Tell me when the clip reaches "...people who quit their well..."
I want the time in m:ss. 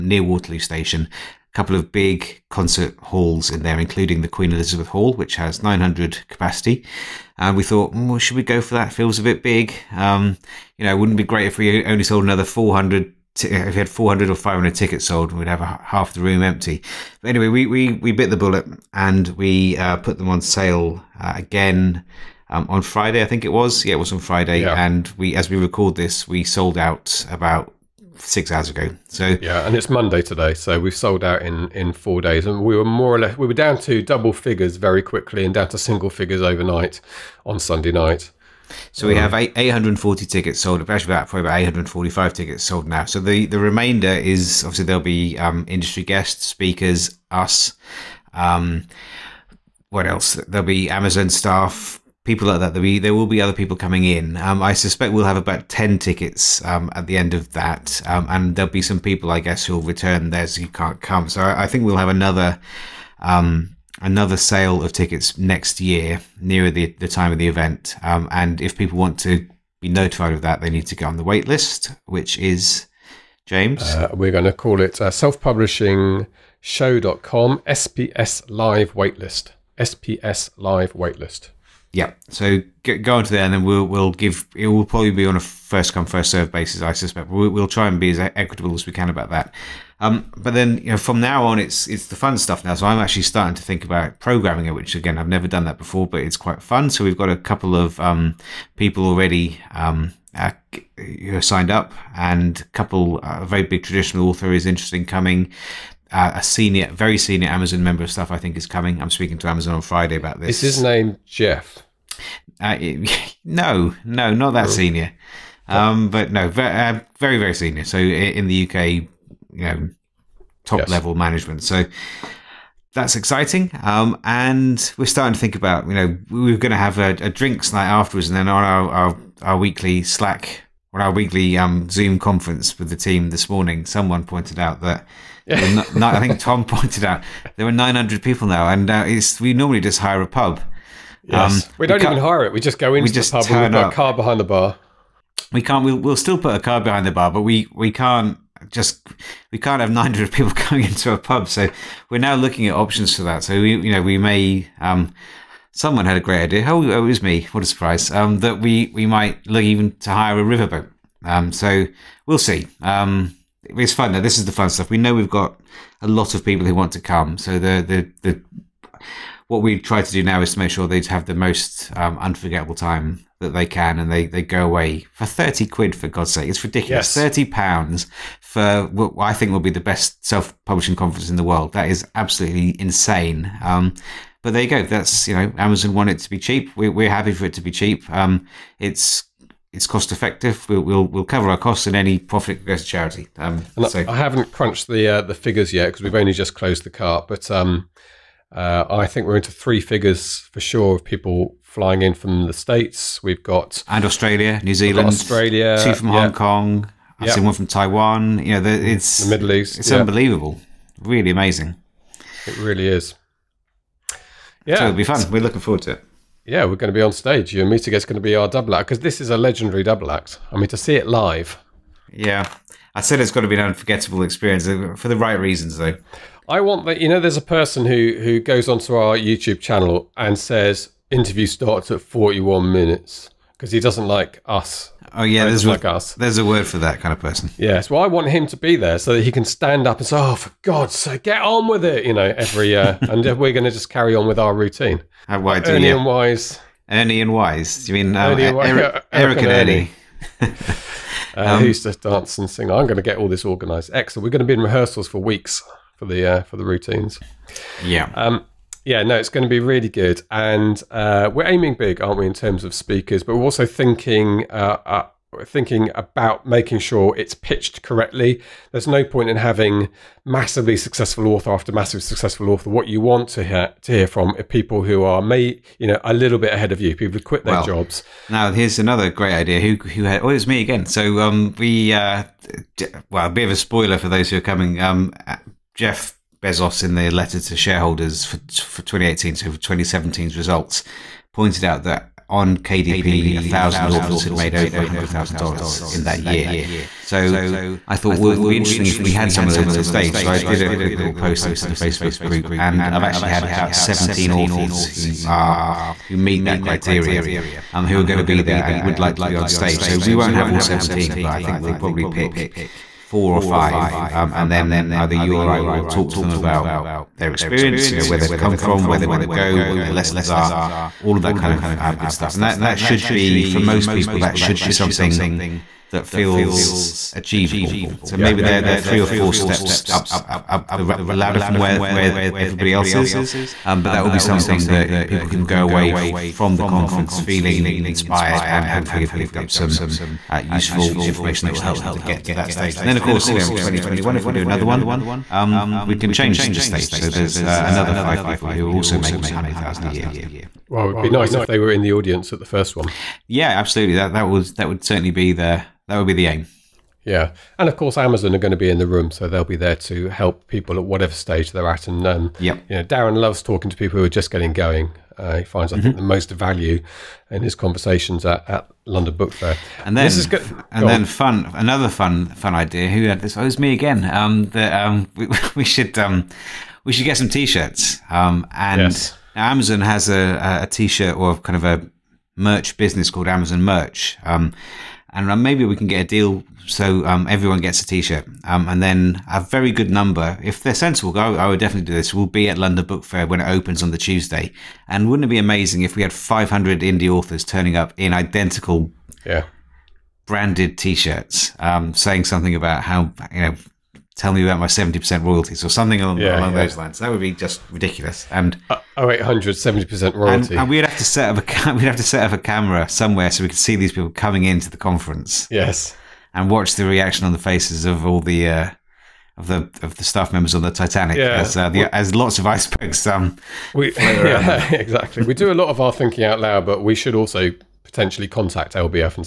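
4:36.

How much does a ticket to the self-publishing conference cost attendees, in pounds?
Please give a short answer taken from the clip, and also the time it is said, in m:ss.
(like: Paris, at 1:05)
£30, at 2:55.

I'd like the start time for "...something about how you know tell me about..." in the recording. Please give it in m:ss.
6:42.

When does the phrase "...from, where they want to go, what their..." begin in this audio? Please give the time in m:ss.
5:18.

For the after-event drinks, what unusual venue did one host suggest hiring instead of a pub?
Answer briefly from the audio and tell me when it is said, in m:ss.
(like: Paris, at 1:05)
A riverboat, at 2:40.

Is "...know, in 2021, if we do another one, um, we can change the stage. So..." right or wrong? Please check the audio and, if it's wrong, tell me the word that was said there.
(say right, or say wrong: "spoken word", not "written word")
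right.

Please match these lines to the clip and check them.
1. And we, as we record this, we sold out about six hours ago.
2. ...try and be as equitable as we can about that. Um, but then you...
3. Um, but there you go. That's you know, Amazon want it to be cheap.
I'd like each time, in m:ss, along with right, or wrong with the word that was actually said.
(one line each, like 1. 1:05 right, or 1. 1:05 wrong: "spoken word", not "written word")
1. 0:24 right
2. 1:27 right
3. 3:03 right.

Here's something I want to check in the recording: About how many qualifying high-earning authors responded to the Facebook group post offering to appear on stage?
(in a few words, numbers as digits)
17.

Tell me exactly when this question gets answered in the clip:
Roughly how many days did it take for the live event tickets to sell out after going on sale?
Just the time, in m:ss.
0:31.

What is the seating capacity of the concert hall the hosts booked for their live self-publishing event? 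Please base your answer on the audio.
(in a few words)
900.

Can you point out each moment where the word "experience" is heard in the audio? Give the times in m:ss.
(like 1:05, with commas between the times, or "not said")
3:44, 5:17.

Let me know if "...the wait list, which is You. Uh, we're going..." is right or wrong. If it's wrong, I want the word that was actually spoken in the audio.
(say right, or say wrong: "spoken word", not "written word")
wrong: "James", not "You".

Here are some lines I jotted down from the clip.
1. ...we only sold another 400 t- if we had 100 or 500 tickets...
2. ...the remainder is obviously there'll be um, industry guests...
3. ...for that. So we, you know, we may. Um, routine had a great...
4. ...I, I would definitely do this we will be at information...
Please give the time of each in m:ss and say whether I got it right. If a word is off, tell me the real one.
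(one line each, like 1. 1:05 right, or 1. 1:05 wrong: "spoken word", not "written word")
1. 0:11 wrong: "400", not "100"
2. 0:43 right
3. 2:33 wrong: "someone", not "routine"
4. 6:31 wrong: "london", not "information".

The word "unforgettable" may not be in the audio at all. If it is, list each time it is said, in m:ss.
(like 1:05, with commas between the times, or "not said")
2:52, 3:43.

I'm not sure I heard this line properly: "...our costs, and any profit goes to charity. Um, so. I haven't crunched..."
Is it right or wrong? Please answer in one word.
right.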